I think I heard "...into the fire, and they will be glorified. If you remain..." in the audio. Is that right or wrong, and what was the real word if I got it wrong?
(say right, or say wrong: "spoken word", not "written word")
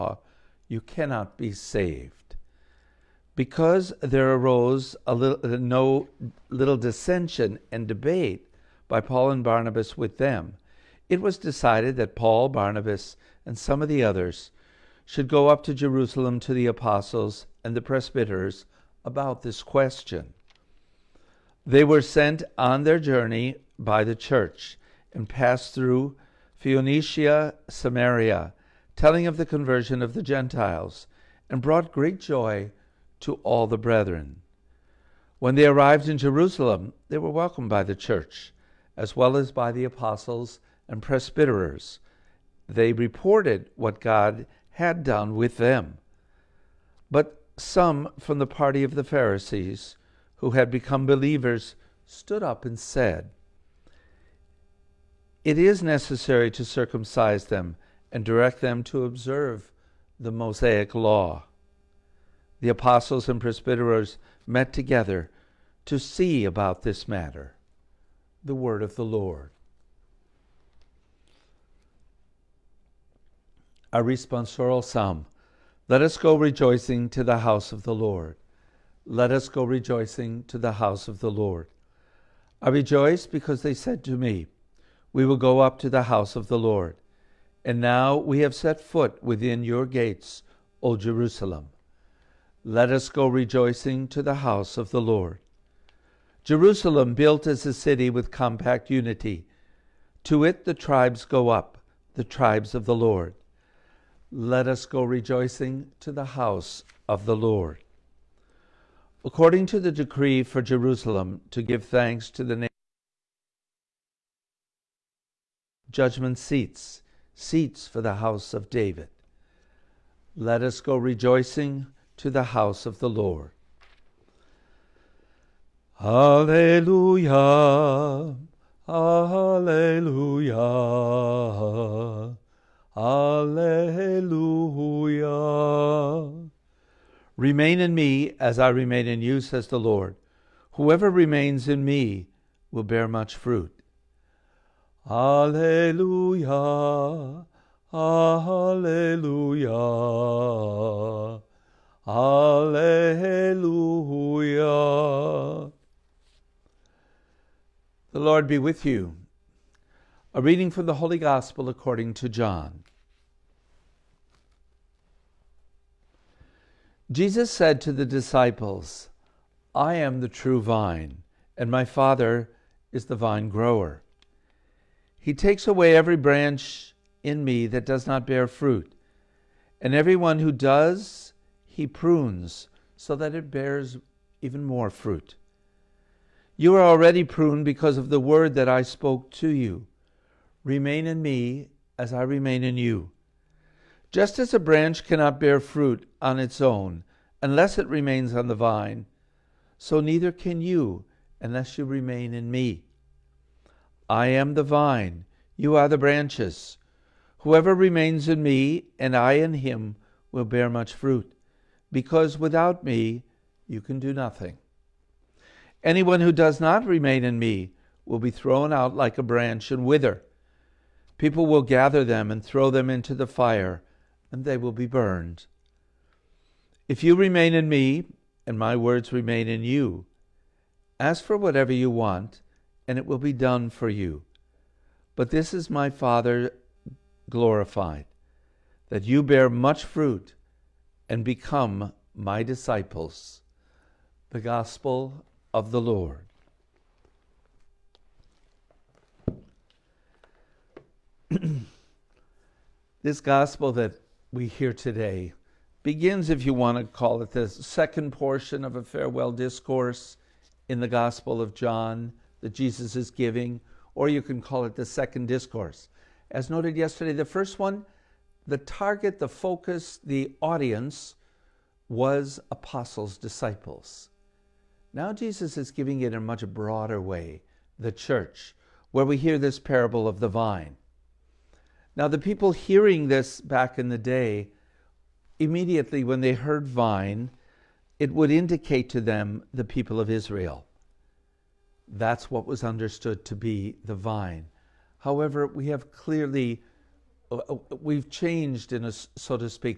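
wrong: "burned", not "glorified".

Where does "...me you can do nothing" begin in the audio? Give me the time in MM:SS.
03:32.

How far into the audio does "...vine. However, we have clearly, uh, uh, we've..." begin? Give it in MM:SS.
04:53.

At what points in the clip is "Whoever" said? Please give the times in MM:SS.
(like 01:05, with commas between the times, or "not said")
02:20, 03:27.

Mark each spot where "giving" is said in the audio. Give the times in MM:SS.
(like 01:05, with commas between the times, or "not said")
04:23, 04:35.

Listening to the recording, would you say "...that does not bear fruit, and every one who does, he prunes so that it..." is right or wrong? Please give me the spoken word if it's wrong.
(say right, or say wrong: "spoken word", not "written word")
right.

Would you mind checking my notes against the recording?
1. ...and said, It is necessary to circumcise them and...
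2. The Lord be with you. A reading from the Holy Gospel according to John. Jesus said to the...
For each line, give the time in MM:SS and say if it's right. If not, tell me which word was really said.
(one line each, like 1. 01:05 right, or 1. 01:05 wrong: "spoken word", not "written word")
1. 00:52 right
2. 02:38 right.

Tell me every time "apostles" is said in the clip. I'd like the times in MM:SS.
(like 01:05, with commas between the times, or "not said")
00:16, 00:39, 01:02, 04:32.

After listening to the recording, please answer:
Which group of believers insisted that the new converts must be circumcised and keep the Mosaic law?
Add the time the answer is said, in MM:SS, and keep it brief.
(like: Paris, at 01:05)
the Pharisees, at 00:48.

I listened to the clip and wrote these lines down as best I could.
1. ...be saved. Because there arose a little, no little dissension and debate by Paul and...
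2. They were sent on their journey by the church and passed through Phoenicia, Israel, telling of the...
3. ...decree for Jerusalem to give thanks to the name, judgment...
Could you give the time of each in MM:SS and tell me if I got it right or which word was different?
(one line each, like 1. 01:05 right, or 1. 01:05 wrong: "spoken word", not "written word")
1. 00:01 right
2. 00:21 wrong: "Samaria", not "Israel"
3. 01:49 right.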